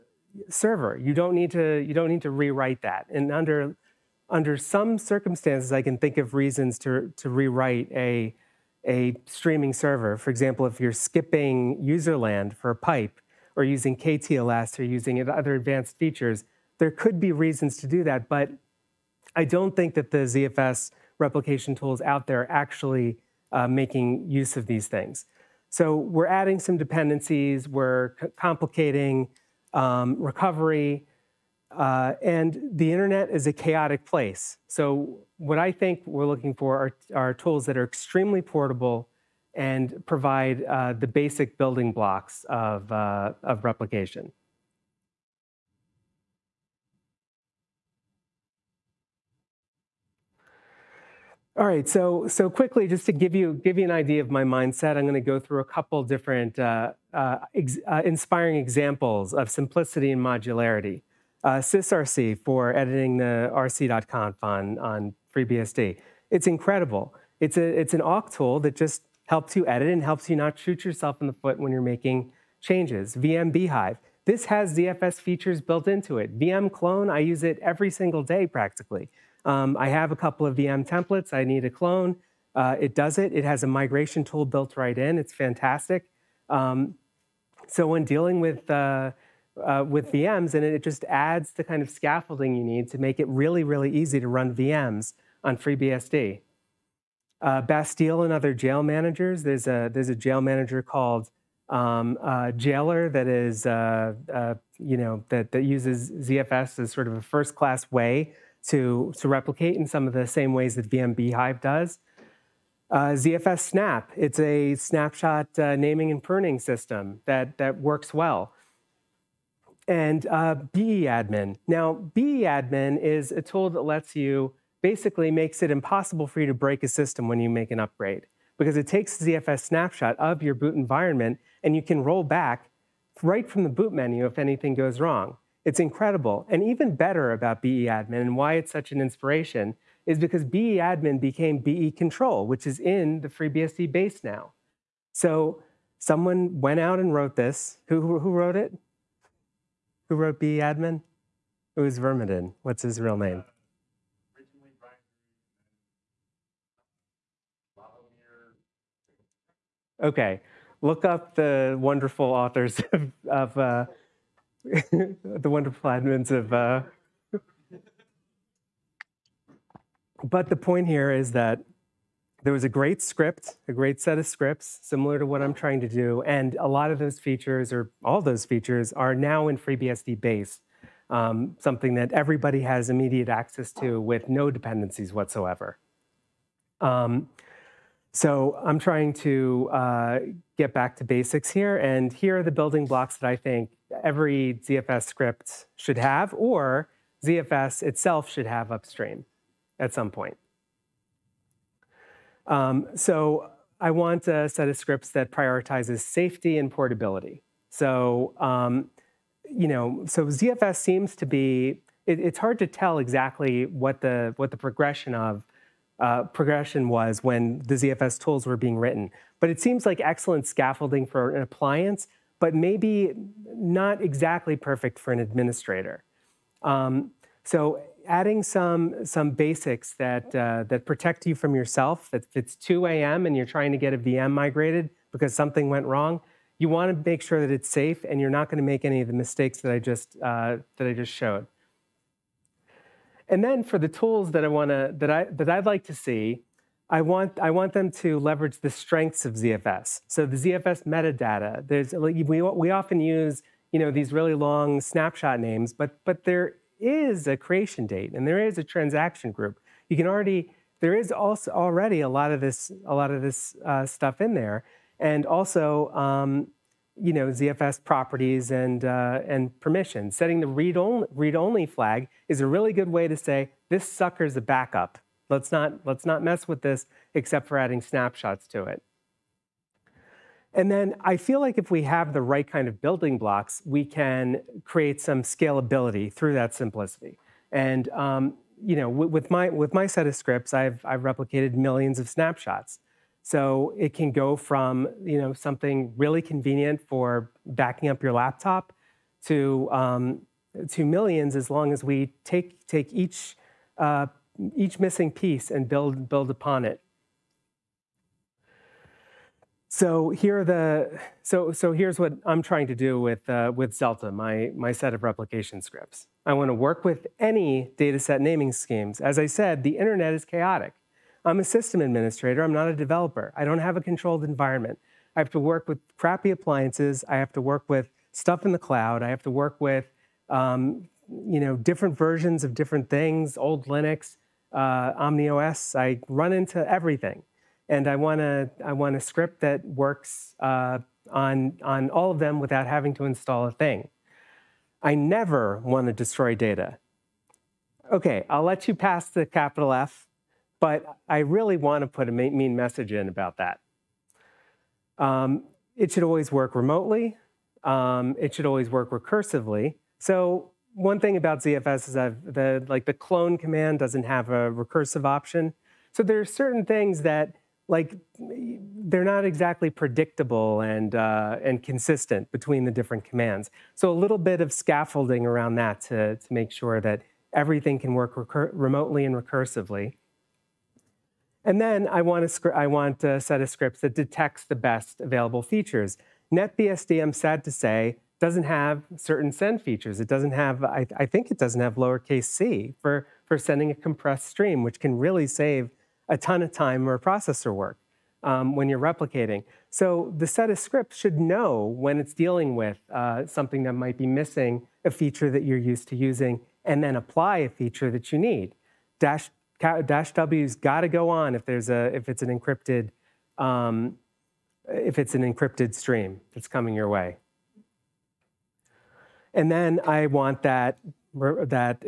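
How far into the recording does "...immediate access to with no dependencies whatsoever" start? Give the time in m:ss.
3:02.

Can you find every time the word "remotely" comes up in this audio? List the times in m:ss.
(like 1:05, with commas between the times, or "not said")
5:56, 6:18.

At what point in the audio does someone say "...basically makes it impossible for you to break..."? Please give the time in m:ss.
2:04.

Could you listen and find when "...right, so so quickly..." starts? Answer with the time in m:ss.
0:51.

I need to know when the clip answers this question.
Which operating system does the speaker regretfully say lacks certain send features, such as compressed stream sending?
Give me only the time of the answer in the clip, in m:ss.
6:26.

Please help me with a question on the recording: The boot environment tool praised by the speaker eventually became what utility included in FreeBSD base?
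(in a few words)
BE control.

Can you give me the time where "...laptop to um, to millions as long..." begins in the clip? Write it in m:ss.
4:58.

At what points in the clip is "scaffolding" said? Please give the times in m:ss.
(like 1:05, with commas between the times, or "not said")
1:31, 3:40, 6:14.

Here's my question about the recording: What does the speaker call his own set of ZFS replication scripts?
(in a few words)
Zelta.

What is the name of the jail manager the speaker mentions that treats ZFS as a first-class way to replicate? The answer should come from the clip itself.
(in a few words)
Jailer.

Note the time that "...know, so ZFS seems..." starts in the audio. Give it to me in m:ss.
3:29.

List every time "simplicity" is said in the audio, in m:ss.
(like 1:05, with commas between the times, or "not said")
0:59, 4:46.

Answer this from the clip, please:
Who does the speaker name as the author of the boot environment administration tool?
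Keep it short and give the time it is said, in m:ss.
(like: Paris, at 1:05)
vermaden, at 2:31.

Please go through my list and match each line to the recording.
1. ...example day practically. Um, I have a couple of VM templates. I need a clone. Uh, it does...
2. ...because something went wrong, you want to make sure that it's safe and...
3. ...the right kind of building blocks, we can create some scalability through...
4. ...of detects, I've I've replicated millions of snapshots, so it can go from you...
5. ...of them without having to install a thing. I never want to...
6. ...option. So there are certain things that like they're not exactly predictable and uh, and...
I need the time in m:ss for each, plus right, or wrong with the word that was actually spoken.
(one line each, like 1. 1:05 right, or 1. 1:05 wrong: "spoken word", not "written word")
1. 1:17 wrong: "single", not "example"
2. 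3:55 right
3. 4:42 right
4. 4:50 wrong: "scripts", not "detects"
5. 5:42 right
6. 6:05 right.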